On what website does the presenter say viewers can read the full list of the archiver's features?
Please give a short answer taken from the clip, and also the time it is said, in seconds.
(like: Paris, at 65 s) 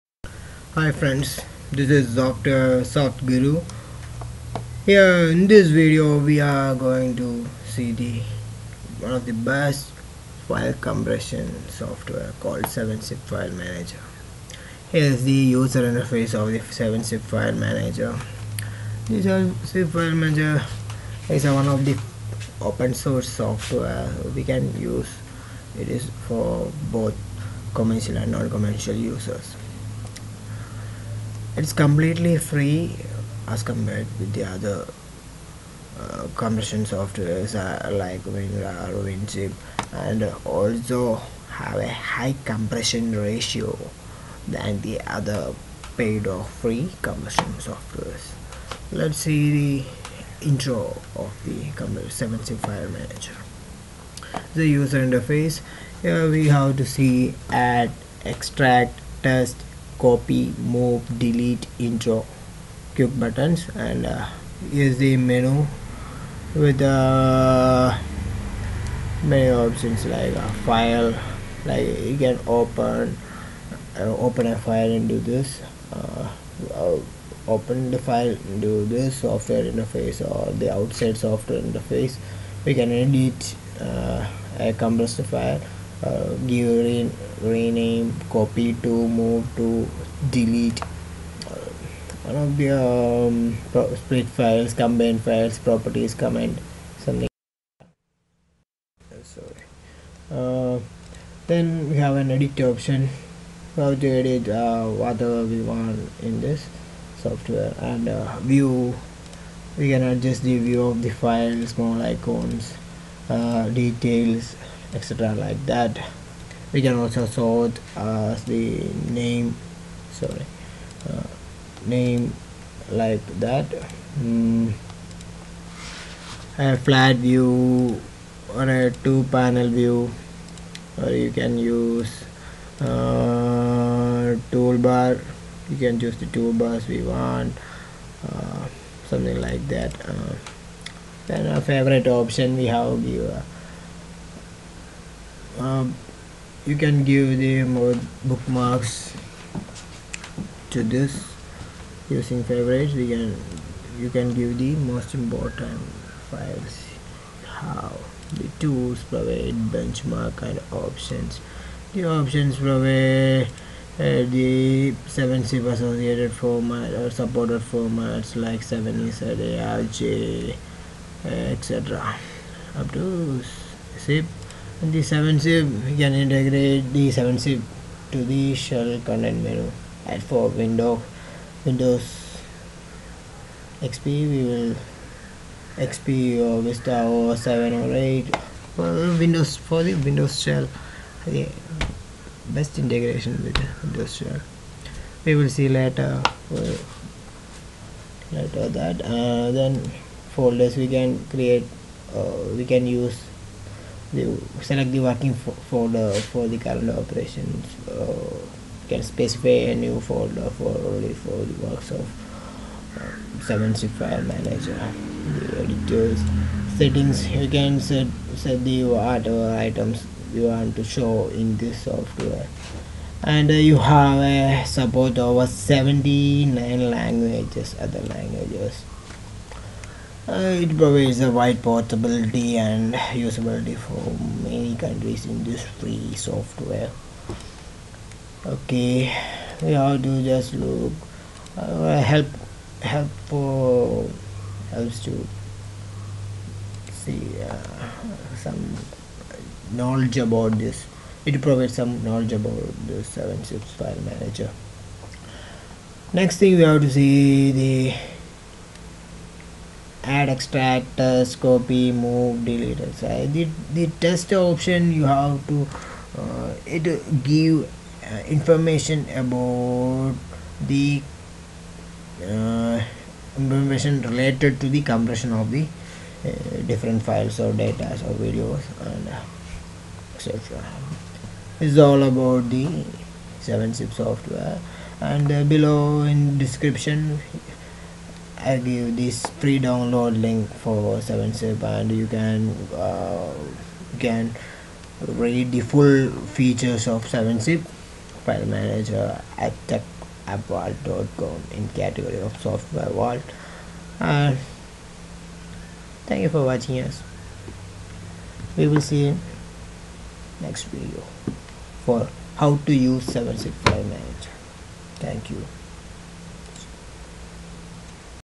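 tecappvault.com, at 299 s.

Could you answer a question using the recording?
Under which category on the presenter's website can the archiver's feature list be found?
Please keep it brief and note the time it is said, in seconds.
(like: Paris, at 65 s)
software vault, at 302 s.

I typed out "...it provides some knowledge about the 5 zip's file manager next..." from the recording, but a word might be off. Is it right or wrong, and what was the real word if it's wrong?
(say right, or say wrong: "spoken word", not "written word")
wrong: "7", not "5".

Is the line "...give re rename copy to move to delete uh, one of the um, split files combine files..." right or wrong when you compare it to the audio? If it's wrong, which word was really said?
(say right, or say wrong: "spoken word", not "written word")
right.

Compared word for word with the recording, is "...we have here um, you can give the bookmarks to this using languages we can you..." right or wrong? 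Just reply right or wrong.
wrong.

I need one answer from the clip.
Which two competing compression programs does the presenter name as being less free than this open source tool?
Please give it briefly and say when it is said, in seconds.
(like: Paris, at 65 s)
WinRAR, WinZip, at 38 s.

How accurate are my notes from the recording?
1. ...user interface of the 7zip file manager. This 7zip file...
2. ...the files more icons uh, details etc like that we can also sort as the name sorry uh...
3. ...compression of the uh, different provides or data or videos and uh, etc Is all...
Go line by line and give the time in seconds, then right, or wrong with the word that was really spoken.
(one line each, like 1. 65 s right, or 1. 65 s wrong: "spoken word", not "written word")
1. 15 s right
2. 111 s right
3. 274 s wrong: "files", not "provides".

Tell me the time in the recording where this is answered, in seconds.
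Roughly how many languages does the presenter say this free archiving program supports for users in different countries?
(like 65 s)
225 s.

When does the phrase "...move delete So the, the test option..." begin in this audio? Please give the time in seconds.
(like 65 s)
261 s.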